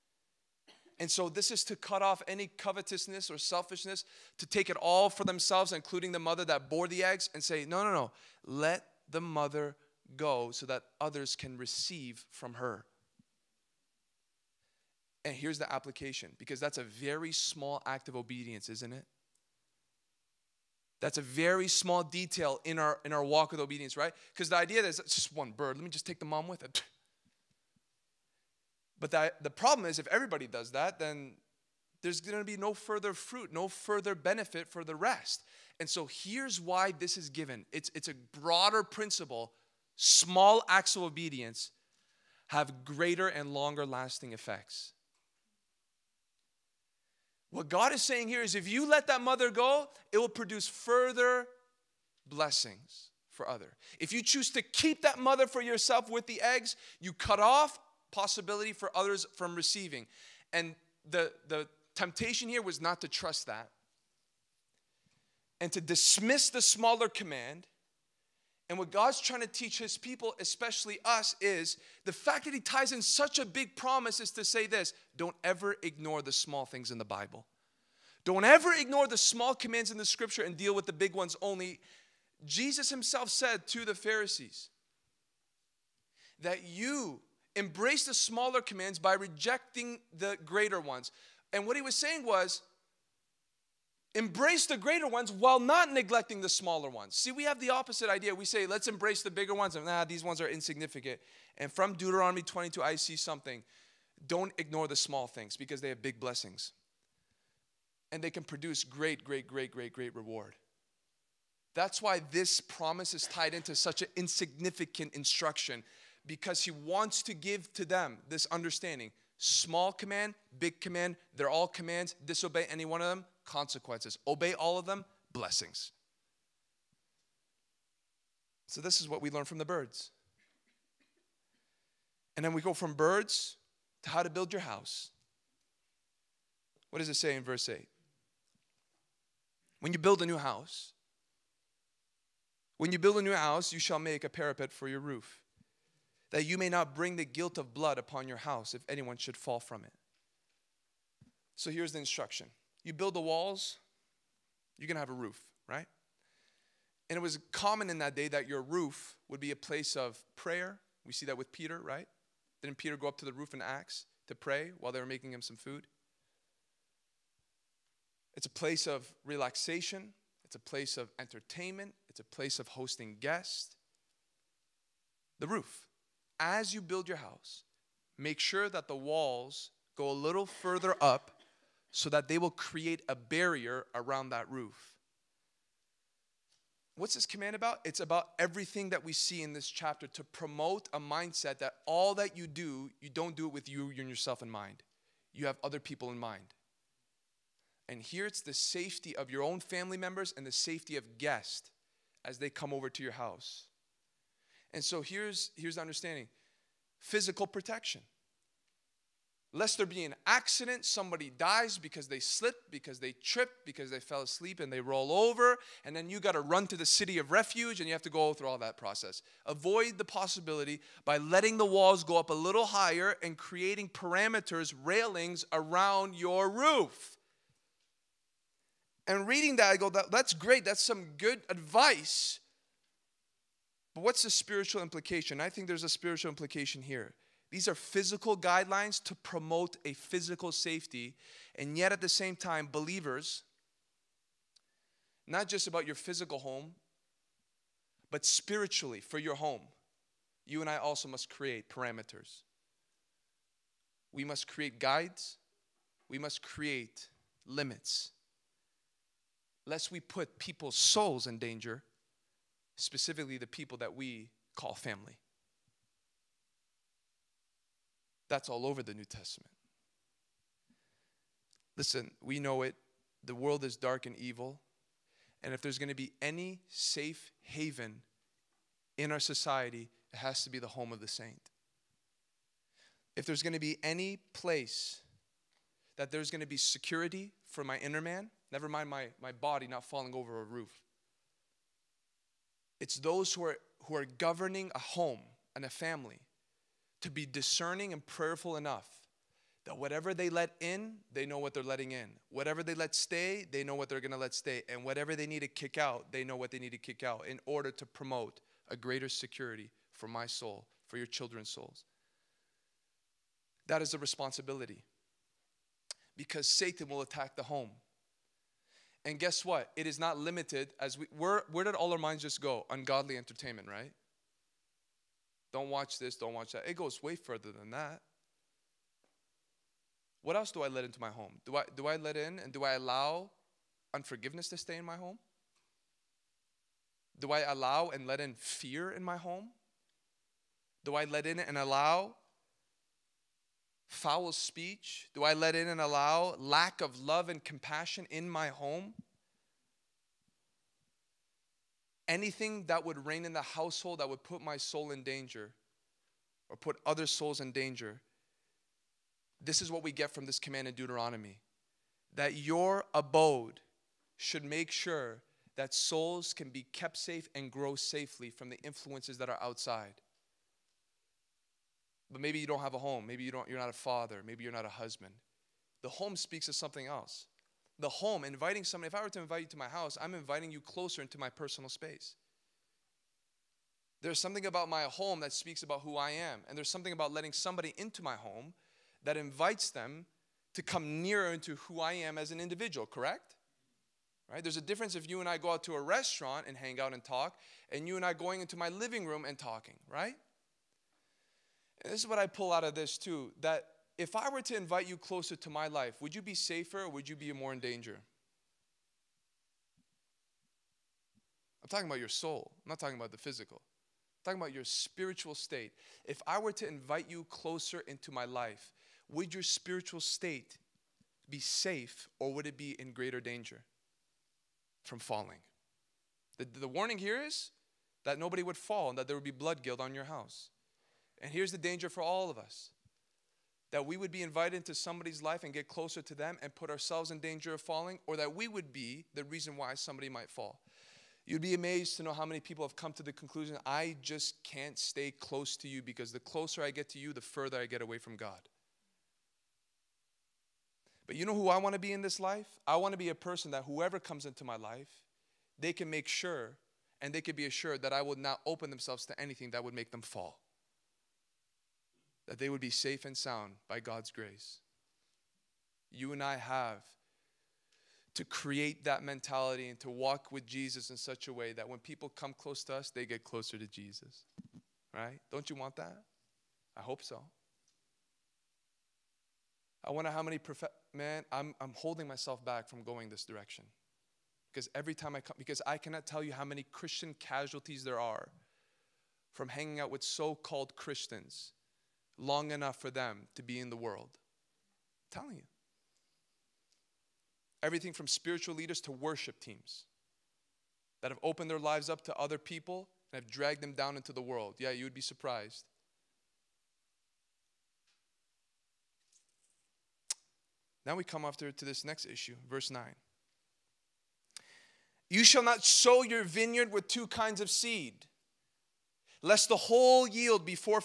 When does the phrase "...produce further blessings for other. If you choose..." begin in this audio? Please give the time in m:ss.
0:50.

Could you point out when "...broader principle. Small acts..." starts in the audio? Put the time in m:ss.
0:38.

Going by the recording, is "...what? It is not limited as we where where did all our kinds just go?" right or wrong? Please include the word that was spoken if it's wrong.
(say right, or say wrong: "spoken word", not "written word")
wrong: "minds", not "kinds".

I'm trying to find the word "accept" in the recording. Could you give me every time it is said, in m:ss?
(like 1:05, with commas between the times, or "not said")
not said.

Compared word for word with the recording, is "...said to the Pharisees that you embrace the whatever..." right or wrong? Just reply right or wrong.
wrong.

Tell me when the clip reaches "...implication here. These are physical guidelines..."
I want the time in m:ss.
3:56.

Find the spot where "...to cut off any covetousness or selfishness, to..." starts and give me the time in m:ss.
0:01.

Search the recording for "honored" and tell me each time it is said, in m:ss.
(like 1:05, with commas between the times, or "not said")
not said.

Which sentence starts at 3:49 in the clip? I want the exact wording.
And reading that, I go, that, that's great.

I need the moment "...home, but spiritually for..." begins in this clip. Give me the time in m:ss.
4:06.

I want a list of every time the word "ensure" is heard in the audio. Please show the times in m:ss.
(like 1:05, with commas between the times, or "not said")
not said.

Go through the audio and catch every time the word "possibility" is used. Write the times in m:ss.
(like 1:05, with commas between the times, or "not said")
0:58, 3:40.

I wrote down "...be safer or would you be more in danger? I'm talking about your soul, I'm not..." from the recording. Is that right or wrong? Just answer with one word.
right.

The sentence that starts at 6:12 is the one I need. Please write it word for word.
But maybe you don't have a home.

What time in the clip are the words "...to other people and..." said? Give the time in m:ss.
8:22.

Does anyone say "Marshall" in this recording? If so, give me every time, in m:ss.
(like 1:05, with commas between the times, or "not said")
not said.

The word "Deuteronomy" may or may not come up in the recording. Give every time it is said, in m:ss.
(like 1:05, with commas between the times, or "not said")
1:41, 6:00.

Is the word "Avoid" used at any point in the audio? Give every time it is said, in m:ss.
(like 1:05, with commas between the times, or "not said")
3:39.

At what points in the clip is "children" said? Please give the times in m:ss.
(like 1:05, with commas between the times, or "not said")
5:11.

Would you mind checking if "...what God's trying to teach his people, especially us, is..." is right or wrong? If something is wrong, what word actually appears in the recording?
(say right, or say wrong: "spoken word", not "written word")
right.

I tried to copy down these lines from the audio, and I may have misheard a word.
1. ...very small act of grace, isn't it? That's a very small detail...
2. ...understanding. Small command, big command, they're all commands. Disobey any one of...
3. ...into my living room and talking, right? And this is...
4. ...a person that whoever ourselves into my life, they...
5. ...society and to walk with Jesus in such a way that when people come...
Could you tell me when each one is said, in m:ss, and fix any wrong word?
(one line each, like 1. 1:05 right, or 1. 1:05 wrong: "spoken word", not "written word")
1. 0:16 wrong: "obedience", not "grace"
2. 1:58 right
3. 6:38 right
4. 7:33 wrong: "comes", not "ourselves"
5. 7:49 wrong: "mentality", not "society".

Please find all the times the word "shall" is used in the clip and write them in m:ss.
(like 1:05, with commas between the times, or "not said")
2:23, 8:35.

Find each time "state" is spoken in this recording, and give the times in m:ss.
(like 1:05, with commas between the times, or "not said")
6:55, 7:00.